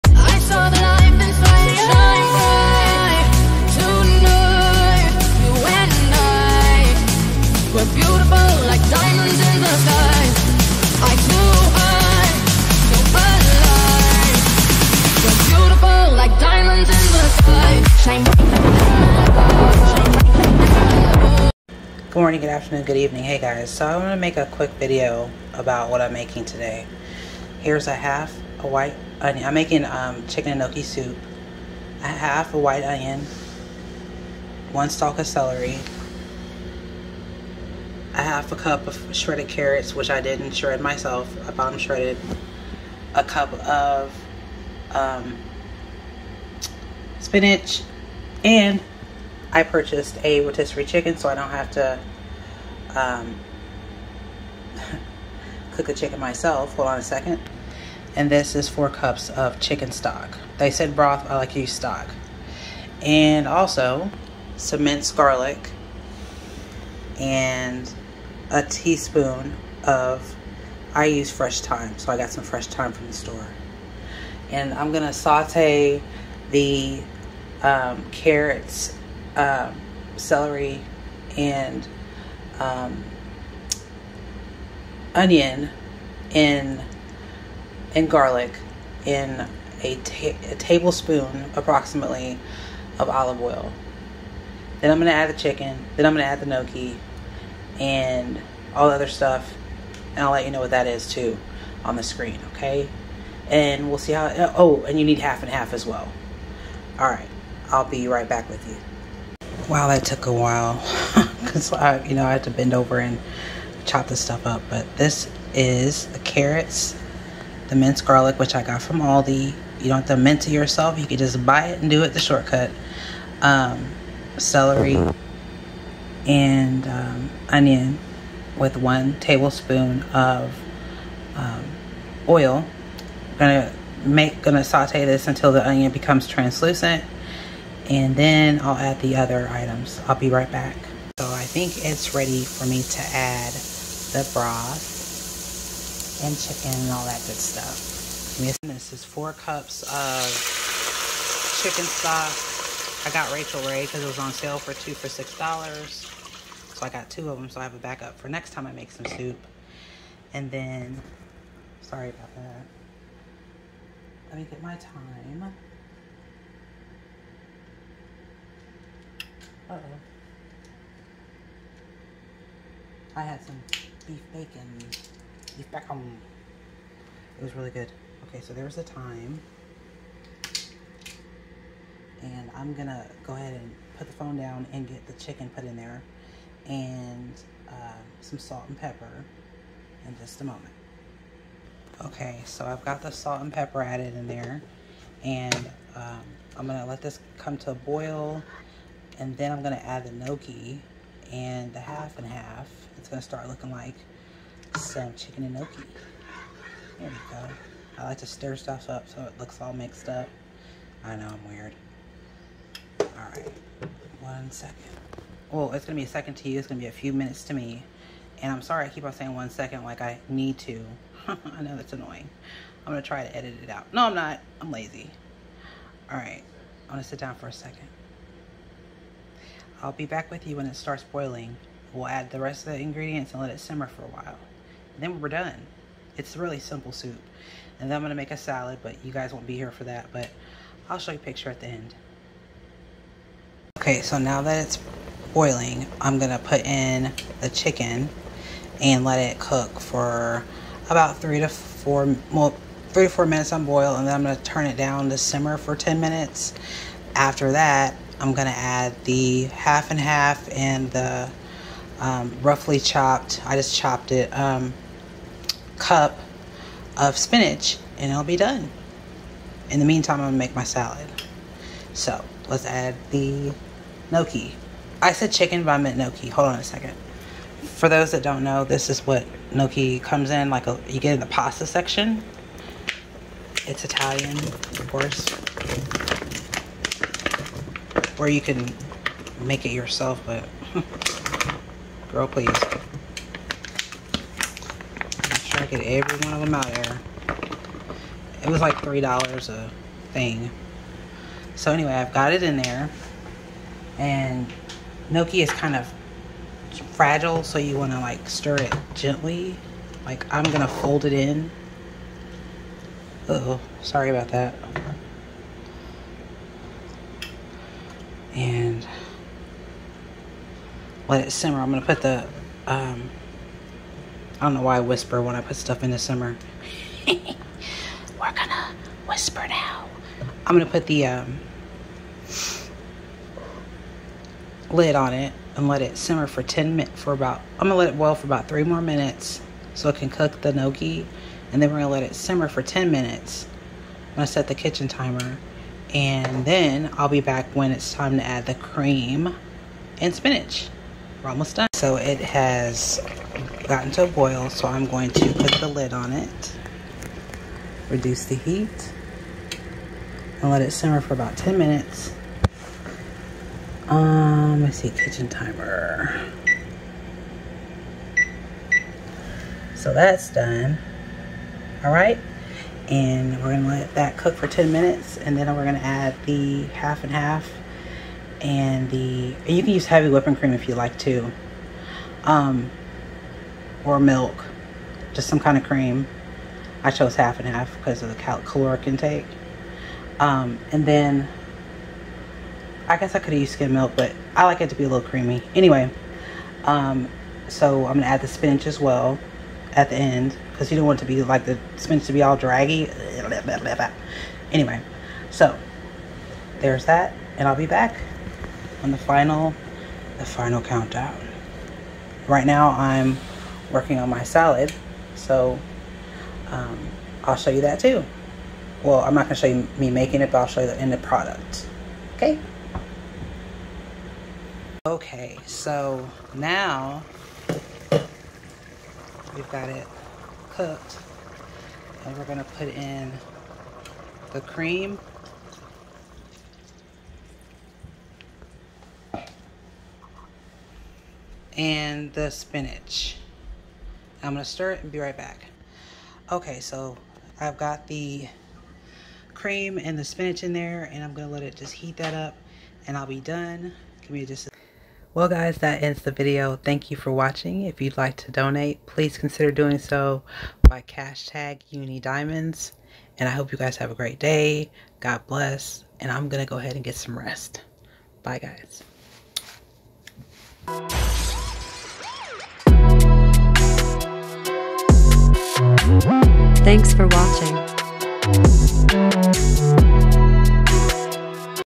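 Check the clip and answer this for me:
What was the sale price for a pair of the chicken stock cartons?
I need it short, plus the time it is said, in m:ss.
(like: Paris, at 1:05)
two for $6, at 2:34.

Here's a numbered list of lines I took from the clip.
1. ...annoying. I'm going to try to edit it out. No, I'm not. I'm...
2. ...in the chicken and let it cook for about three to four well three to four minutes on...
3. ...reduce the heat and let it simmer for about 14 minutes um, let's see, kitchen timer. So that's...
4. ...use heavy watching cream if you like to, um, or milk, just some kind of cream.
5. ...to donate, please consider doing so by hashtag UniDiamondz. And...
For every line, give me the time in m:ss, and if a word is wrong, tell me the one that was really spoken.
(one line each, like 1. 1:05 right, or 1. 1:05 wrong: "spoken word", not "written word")
1. 3:41 right
2. 4:06 right
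3. 5:57 wrong: "10", not "14"
4. 6:19 wrong: "whipping", not "watching"
5. 7:38 right.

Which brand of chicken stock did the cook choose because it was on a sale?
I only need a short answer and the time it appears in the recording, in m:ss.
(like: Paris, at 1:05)
Rachael Ray, at 2:33.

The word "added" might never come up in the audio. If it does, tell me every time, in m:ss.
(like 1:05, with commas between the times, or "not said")
3:13.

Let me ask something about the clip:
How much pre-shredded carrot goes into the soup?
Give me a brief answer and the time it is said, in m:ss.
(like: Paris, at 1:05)
half a cup, at 0:38.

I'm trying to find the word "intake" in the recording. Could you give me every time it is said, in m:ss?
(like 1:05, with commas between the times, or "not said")
6:28.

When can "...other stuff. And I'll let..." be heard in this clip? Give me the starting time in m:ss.
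1:38.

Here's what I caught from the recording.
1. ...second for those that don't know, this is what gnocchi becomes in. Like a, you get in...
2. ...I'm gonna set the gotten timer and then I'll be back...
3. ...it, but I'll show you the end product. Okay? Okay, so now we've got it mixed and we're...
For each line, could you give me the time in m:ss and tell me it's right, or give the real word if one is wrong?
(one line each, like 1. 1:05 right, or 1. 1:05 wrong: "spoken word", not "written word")
1. 4:36 wrong: "comes", not "becomes"
2. 5:44 wrong: "kitchen", not "gotten"
3. 7:00 wrong: "cooked", not "mixed".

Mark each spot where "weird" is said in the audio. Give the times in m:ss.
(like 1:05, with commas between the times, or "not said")
3:31.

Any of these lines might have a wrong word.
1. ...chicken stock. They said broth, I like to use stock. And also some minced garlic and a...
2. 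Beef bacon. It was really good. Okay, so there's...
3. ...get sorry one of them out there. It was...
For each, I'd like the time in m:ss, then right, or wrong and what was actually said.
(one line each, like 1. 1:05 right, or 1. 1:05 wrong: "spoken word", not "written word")
1. 0:59 right
2. 2:55 right
3. 4:55 wrong: "every", not "sorry".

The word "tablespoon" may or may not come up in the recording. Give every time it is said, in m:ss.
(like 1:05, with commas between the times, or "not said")
1:30, 2:09.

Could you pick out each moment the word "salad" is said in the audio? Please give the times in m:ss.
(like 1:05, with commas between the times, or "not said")
3:58, 4:30, 6:54.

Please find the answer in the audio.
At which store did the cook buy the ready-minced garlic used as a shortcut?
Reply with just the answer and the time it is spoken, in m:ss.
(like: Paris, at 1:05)
Aldi, at 1:58.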